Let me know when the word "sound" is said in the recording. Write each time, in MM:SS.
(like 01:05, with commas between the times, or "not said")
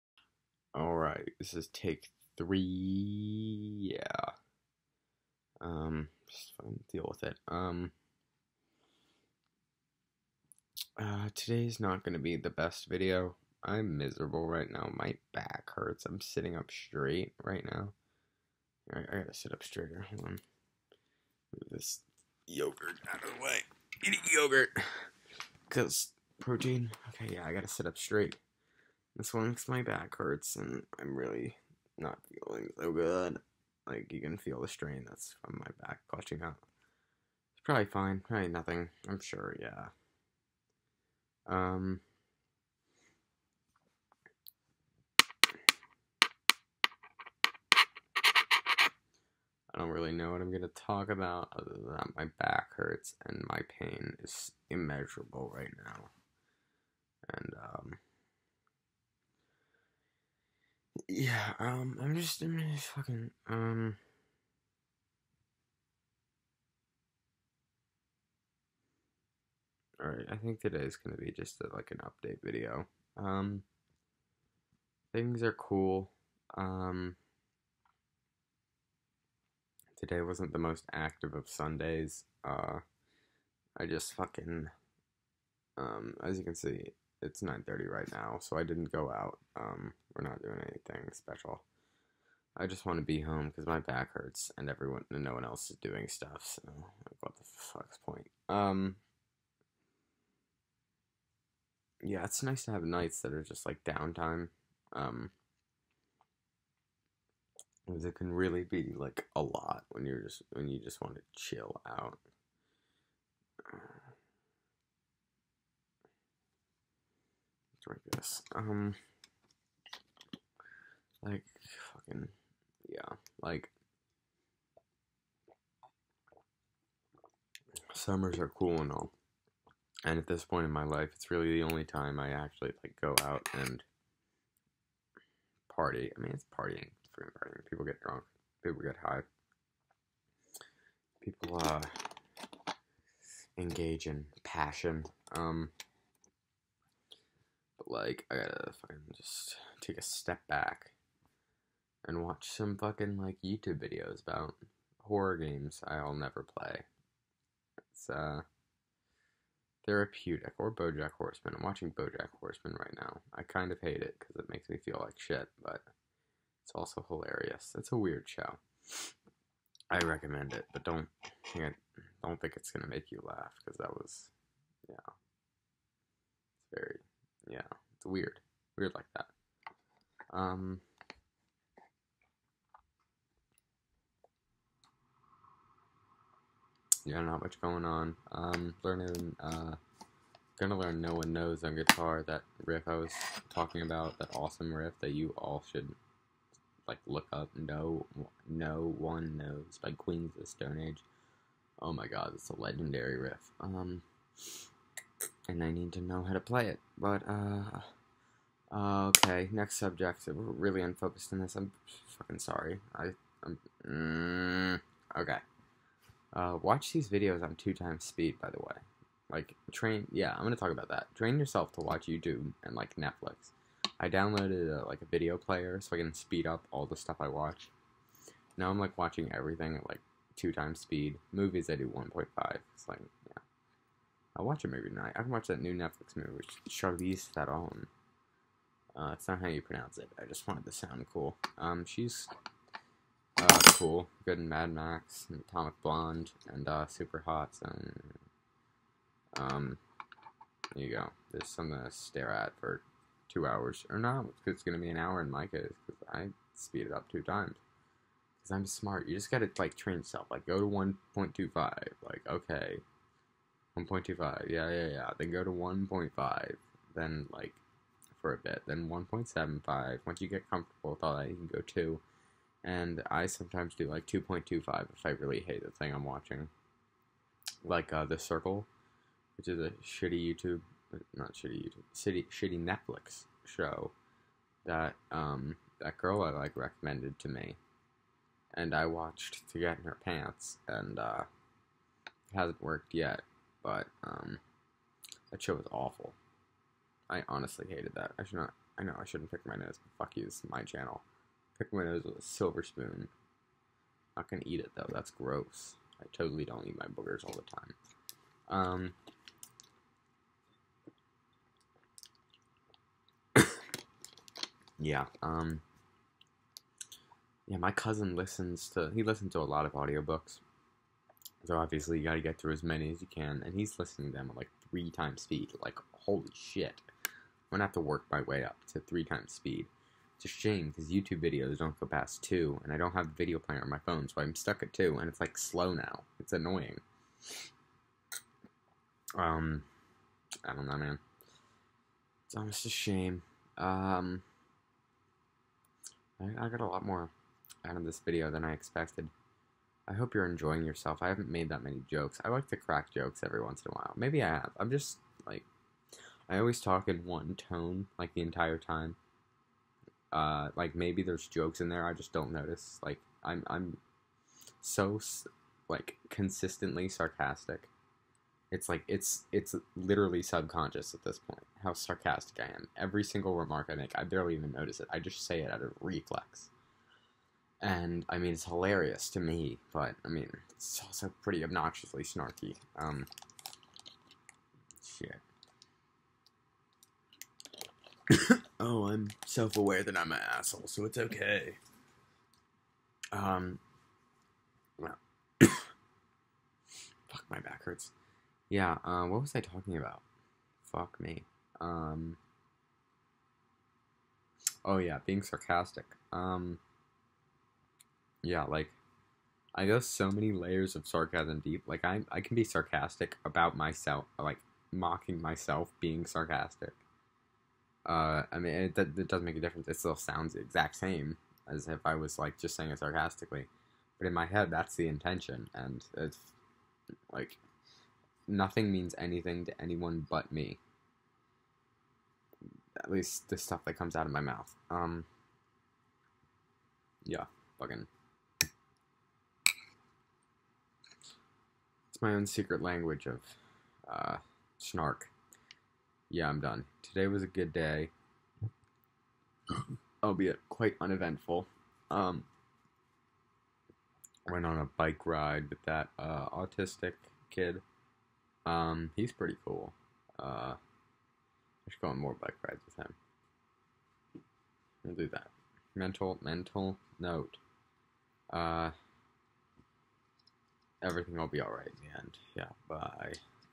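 04:00, 06:59.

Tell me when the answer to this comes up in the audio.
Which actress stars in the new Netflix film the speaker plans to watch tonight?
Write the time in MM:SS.
03:56.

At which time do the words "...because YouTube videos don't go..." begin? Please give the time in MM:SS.
05:30.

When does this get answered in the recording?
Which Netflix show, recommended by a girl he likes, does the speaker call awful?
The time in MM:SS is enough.
04:38.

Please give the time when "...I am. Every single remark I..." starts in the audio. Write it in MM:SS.
06:12.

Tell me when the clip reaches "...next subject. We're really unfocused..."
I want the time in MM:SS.
03:29.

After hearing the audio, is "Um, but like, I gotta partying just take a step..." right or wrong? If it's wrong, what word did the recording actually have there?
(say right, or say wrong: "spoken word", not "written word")
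wrong: "fucking", not "partying".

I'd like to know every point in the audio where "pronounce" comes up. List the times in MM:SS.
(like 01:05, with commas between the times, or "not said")
03:59.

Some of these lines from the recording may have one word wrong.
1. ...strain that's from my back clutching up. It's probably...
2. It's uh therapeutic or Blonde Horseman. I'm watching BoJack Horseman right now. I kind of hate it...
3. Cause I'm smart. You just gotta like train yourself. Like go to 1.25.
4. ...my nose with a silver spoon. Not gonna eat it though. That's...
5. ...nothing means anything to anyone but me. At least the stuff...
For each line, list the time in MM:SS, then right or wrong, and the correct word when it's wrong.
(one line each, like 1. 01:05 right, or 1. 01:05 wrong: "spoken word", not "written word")
1. 00:34 right
2. 02:37 wrong: "BoJack", not "Blonde"
3. 04:18 right
4. 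05:01 right
5. 07:08 right.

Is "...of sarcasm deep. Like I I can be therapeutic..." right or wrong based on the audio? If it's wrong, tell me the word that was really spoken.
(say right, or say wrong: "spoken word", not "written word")
wrong: "sarcastic", not "therapeutic".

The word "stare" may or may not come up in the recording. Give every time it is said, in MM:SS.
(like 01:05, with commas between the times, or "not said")
04:11.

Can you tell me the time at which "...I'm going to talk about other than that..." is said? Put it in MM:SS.
00:50.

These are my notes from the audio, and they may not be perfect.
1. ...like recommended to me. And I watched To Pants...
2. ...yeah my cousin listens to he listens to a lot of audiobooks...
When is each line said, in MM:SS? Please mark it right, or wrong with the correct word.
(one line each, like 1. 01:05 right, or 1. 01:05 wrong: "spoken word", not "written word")
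1. 04:46 wrong: "Get", not "Pants"
2. 05:17 right.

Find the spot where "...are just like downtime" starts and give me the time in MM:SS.
01:43.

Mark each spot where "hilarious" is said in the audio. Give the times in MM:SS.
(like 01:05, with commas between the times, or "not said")
02:47, 06:18.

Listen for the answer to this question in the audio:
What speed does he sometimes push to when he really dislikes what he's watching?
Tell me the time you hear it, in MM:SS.
04:34.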